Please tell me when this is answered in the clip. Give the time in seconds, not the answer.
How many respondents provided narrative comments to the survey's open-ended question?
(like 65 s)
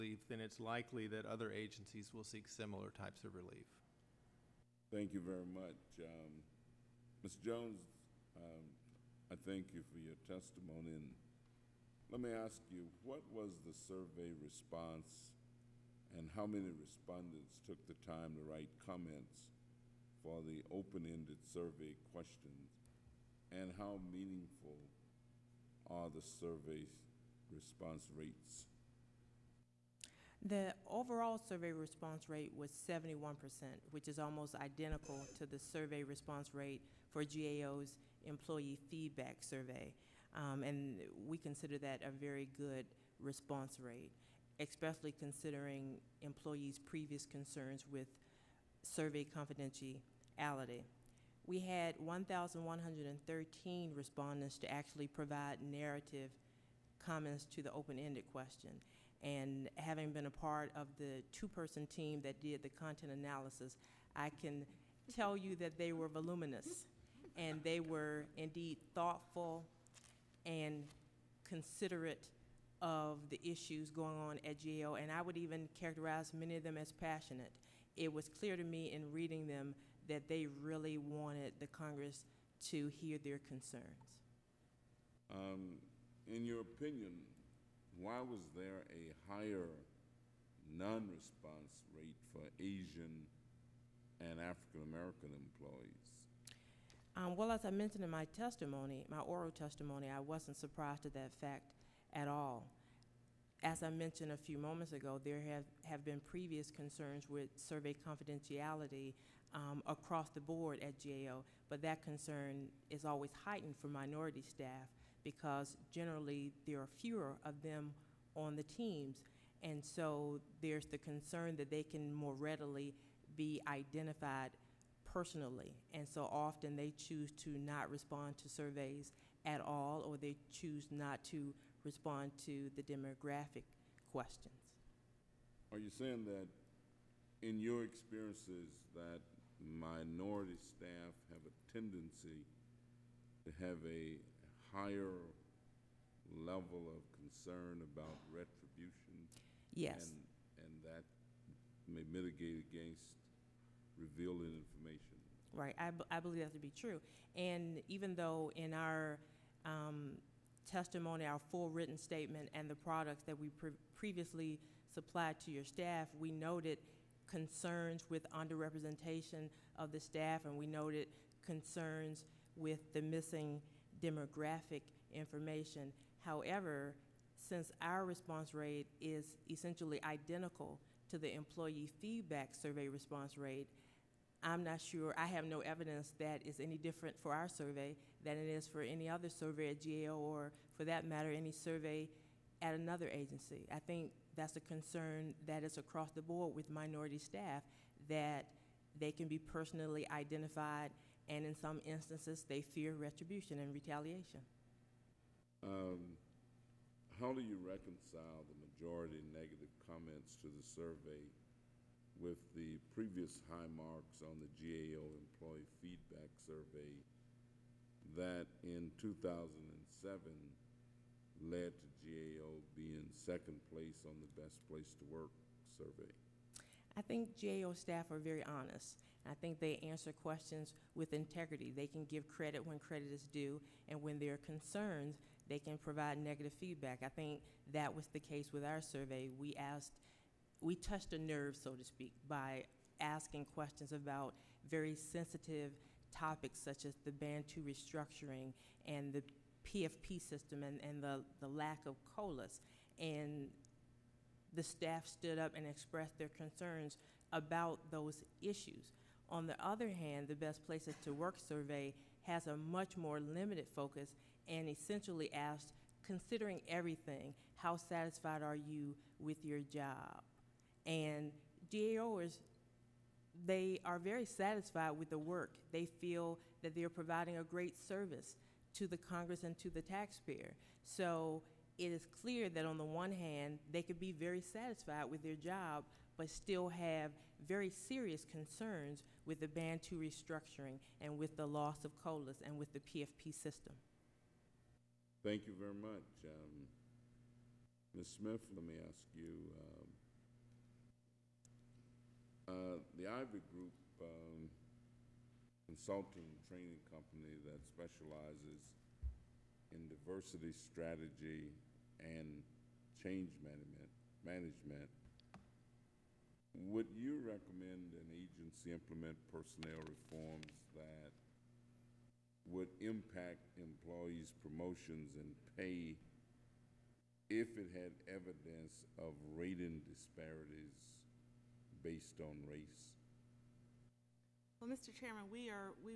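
51 s.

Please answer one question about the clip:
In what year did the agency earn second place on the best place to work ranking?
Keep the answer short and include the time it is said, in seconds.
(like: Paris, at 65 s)
2007, at 218 s.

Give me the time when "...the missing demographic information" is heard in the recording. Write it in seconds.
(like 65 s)
172 s.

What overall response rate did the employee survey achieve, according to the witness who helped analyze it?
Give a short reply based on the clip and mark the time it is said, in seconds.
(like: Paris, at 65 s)
71%, at 32 s.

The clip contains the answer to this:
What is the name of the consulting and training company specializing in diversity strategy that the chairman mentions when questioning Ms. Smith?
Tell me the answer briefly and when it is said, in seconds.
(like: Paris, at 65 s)
Ivy Group, at 303 s.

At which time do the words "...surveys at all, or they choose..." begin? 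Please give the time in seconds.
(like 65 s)
128 s.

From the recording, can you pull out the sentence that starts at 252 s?
And the staff stood up and expressed their concerns about those issues.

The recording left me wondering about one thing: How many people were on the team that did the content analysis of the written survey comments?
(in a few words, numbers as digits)
2.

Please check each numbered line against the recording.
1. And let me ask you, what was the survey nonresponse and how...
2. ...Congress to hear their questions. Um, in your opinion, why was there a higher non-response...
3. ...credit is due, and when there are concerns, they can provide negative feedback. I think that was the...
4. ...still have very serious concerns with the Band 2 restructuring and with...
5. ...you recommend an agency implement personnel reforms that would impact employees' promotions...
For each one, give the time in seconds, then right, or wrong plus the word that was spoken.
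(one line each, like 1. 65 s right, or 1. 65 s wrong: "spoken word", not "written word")
1. 10 s wrong: "response", not "nonresponse"
2. 81 s wrong: "concerns", not "questions"
3. 232 s right
4. 286 s right
5. 316 s right.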